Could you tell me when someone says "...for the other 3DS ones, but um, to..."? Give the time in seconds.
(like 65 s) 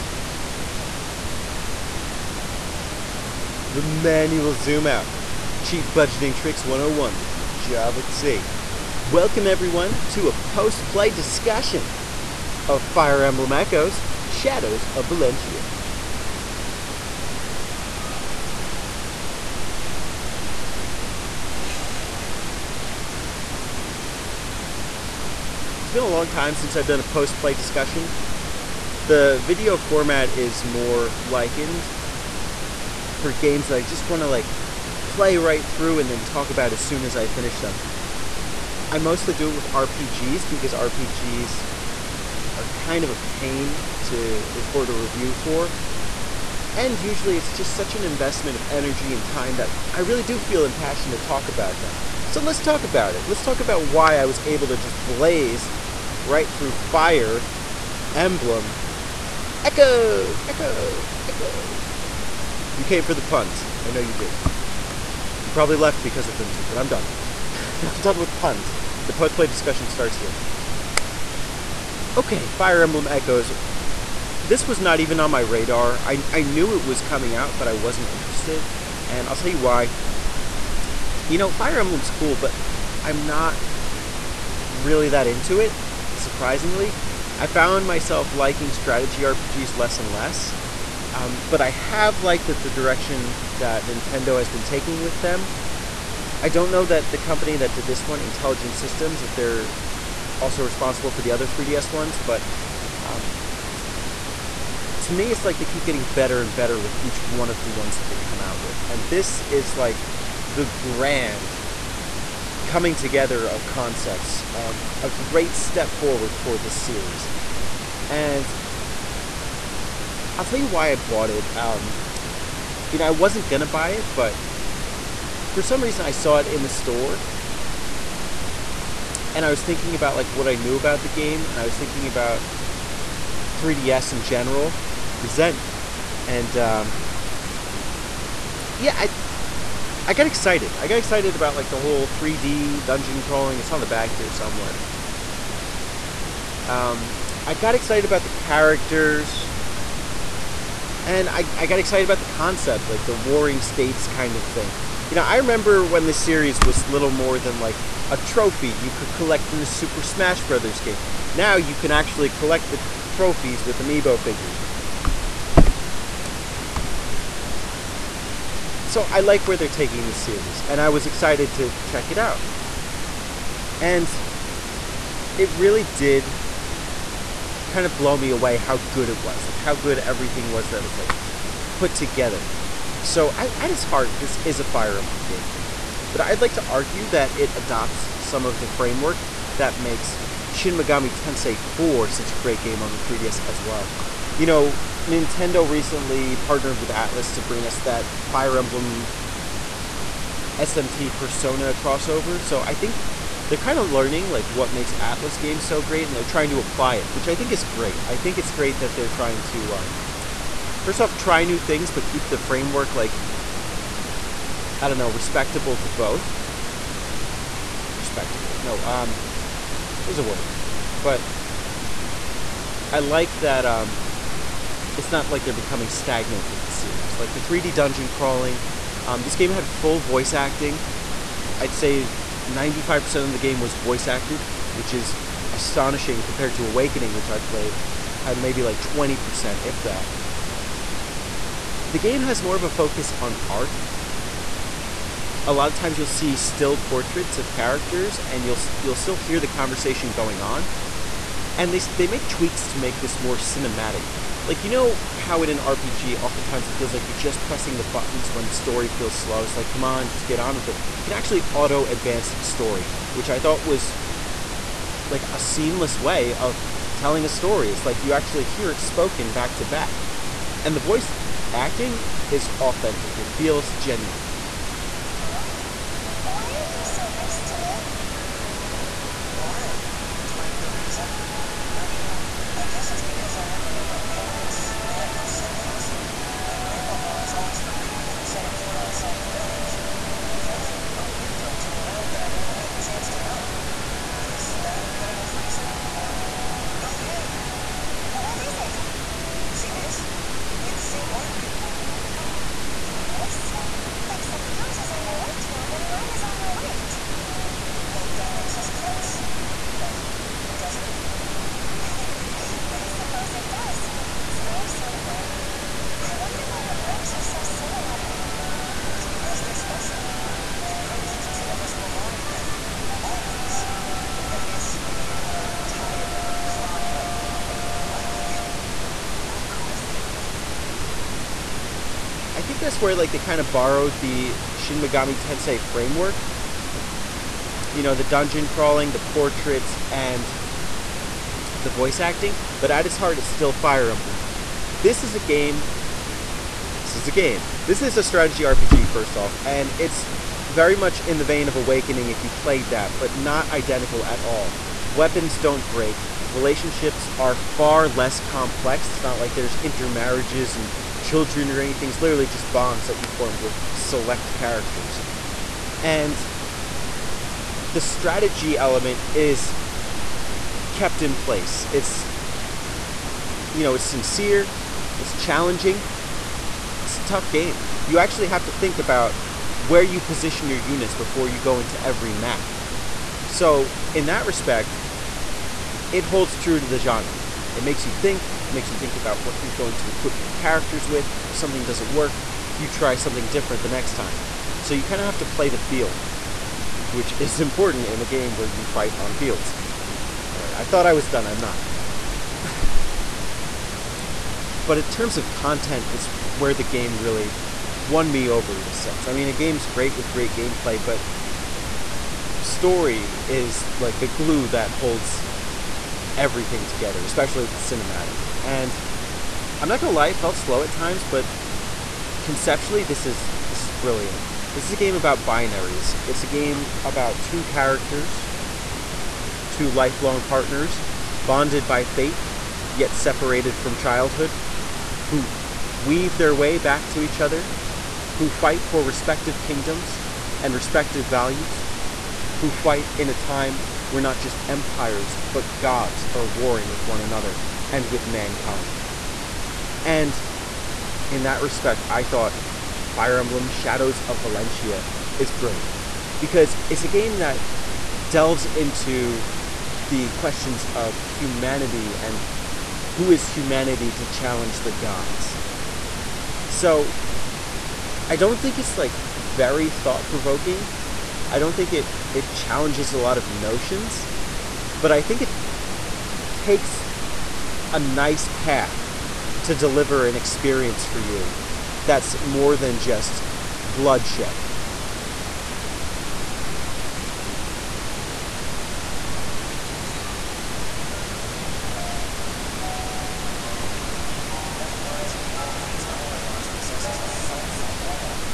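101 s.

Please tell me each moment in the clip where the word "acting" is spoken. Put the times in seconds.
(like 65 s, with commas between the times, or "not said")
230 s, 271 s, 341 s.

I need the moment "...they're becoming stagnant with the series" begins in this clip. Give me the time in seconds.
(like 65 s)
225 s.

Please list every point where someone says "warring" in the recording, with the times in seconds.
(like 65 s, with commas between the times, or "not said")
153 s, 446 s.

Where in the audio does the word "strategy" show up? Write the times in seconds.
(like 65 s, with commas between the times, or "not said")
88 s, 348 s, 367 s.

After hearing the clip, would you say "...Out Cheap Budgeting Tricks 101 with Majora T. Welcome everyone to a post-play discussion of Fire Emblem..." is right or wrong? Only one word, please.
right.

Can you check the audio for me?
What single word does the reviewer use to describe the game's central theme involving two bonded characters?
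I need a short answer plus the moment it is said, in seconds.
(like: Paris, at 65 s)
binaries, at 425 s.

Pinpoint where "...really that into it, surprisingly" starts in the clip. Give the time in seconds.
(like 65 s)
84 s.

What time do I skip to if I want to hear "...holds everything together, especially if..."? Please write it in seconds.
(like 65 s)
414 s.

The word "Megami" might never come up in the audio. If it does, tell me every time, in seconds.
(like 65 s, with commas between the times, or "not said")
190 s, 334 s.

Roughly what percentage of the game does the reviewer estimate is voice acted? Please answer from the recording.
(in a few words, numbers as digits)
95%.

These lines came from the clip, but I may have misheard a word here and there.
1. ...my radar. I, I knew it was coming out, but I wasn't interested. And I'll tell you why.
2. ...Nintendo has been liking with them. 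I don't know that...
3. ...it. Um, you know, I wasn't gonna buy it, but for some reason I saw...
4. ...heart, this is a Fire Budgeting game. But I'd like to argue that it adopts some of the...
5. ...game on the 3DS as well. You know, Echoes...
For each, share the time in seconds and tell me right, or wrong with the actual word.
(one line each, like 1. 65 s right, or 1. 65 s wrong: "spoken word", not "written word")
1. 75 s right
2. 93 s wrong: "taking", not "liking"
3. 121 s right
4. 183 s wrong: "Emblem", not "Budgeting"
5. 192 s wrong: "Nintendo", not "Echoes".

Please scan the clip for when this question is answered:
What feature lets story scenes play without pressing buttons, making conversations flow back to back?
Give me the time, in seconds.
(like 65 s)
261 s.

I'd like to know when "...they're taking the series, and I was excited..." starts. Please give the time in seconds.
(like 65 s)
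169 s.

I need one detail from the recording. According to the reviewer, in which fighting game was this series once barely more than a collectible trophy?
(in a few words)
Super Smash Brothers.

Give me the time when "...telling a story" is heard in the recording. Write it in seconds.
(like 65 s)
266 s.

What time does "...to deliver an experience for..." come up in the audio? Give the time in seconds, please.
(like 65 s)
479 s.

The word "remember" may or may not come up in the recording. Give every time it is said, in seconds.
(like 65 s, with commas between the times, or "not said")
155 s.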